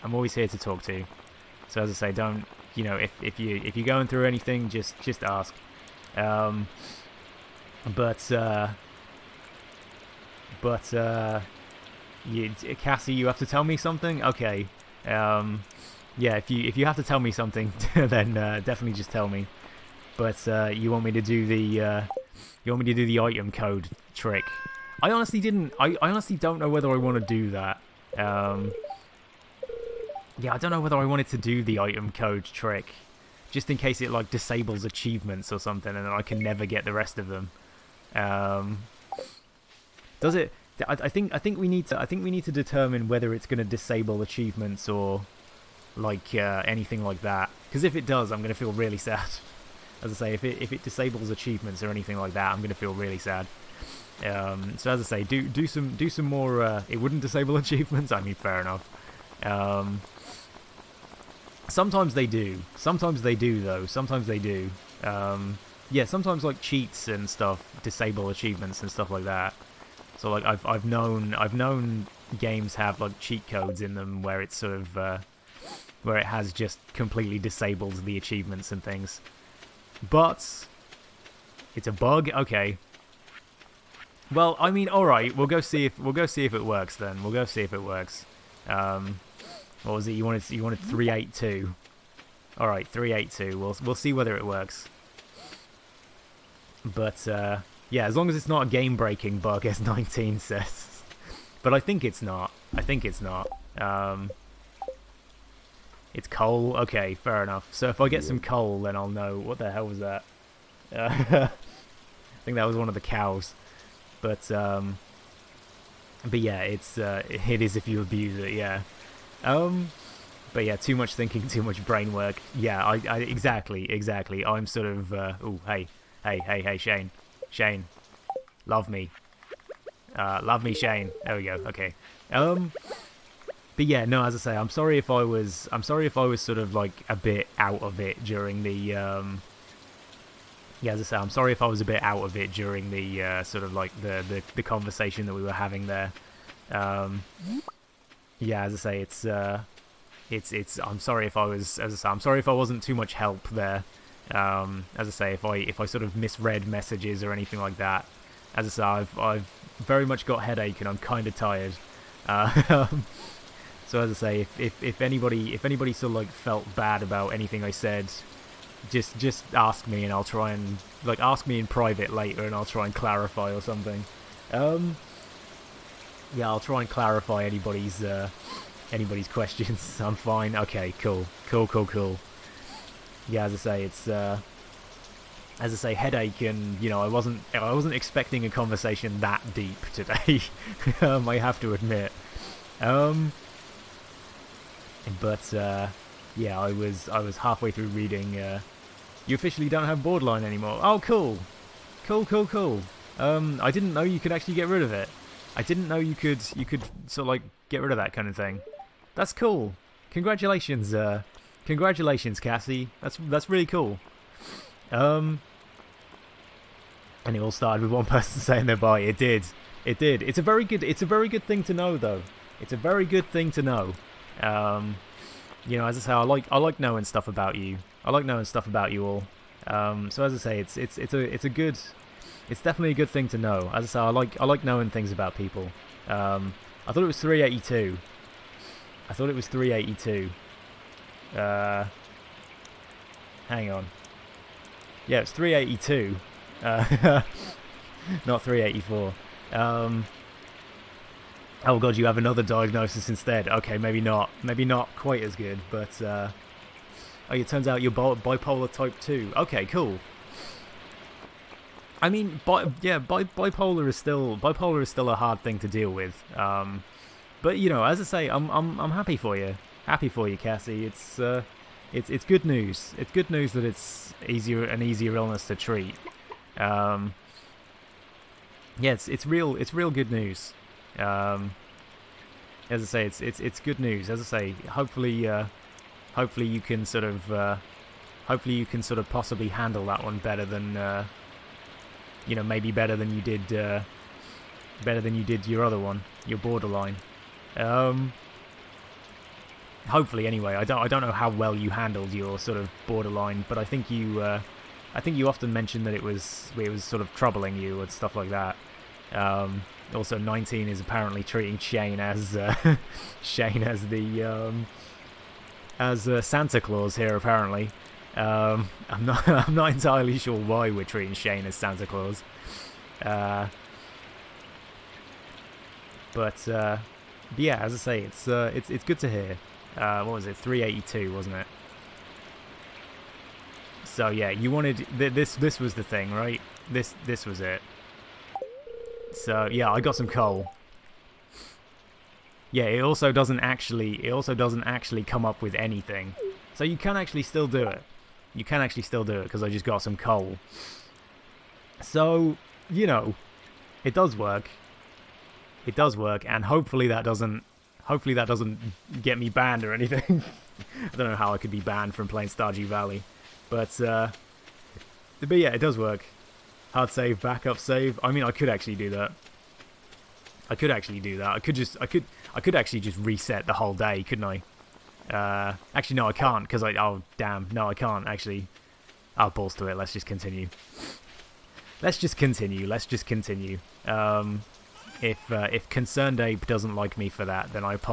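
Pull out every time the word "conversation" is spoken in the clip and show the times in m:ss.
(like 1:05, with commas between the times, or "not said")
2:24, 3:08.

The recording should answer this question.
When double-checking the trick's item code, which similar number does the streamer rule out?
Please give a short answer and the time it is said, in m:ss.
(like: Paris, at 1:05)
384, at 4:08.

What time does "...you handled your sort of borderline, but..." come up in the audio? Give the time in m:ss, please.
5:01.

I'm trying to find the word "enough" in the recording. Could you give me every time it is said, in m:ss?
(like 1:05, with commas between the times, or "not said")
0:58, 1:47.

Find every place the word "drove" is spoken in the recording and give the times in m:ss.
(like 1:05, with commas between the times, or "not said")
not said.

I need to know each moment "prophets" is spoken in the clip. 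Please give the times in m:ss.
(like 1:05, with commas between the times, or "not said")
not said.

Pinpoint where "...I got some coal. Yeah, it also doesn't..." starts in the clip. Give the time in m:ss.
5:39.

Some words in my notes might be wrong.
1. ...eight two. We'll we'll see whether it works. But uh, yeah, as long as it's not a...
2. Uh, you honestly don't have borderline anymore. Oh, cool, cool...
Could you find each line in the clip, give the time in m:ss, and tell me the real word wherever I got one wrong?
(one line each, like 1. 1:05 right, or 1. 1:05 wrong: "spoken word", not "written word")
1. 1:33 right
2. 3:18 wrong: "officially", not "honestly".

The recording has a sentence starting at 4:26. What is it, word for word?
Um, but you know, as I say, I'm I'm I'm happy for you.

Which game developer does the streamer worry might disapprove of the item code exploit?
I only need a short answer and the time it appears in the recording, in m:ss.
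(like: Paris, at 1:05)
ConcernedApe, at 6:25.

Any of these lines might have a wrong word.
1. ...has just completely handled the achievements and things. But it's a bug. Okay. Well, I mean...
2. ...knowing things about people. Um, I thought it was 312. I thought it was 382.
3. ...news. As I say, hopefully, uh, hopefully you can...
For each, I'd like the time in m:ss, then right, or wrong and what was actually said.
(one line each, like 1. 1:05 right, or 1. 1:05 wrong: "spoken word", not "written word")
1. 1:16 wrong: "disabled", not "handled"
2. 3:54 wrong: "382", not "312"
3. 4:43 right.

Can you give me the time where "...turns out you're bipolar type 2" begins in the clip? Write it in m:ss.
4:17.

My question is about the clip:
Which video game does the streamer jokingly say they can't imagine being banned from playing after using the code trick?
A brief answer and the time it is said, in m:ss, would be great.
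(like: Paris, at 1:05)
Stardew Valley, at 6:02.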